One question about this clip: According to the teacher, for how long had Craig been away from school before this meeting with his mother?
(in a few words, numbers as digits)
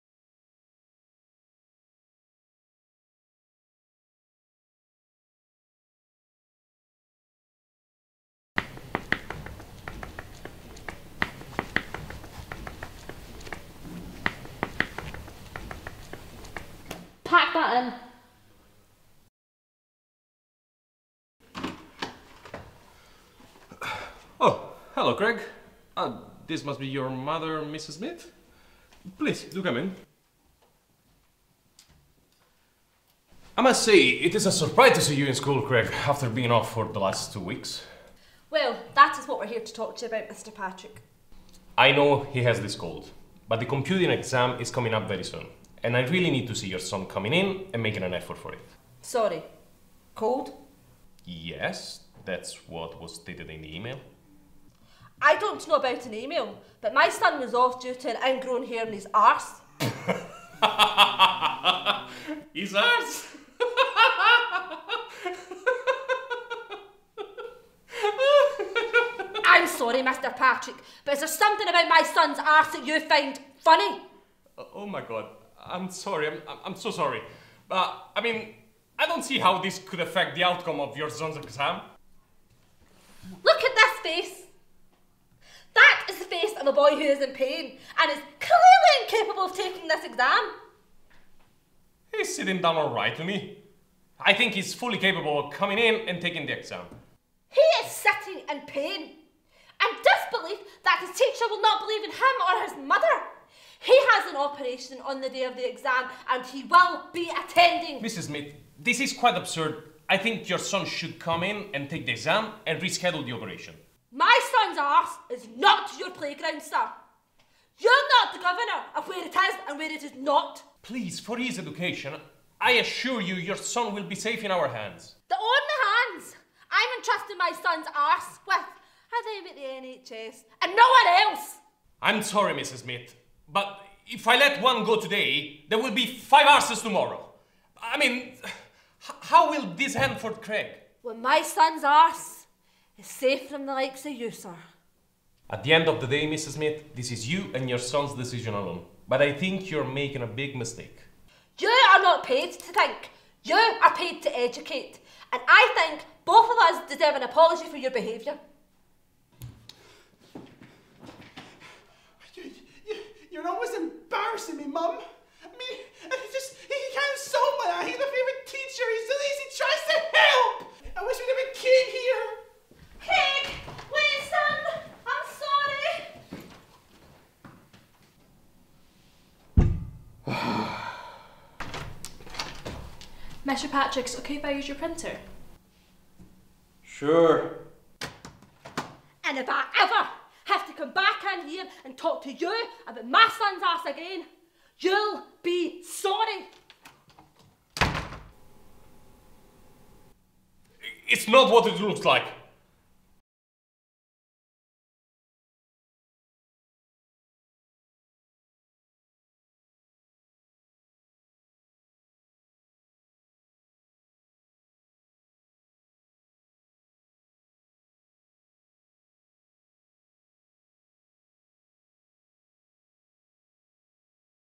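2 weeks.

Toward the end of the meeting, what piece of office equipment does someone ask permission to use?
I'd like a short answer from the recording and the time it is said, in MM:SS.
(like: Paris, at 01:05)
Printer, at 03:04.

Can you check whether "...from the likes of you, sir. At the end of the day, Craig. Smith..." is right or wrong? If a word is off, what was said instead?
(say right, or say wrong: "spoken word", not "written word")
wrong: "Mrs", not "Craig".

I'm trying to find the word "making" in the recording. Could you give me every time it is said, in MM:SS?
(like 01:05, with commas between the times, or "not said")
00:47, 02:29.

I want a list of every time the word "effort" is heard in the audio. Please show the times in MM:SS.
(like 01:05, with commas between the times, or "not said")
00:48.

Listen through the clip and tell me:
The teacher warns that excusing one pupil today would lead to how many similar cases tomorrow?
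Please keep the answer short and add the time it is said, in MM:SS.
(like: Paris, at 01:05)
5, at 02:16.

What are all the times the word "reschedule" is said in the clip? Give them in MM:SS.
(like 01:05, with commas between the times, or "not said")
01:52.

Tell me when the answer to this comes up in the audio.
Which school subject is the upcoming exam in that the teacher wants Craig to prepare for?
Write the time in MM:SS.
00:43.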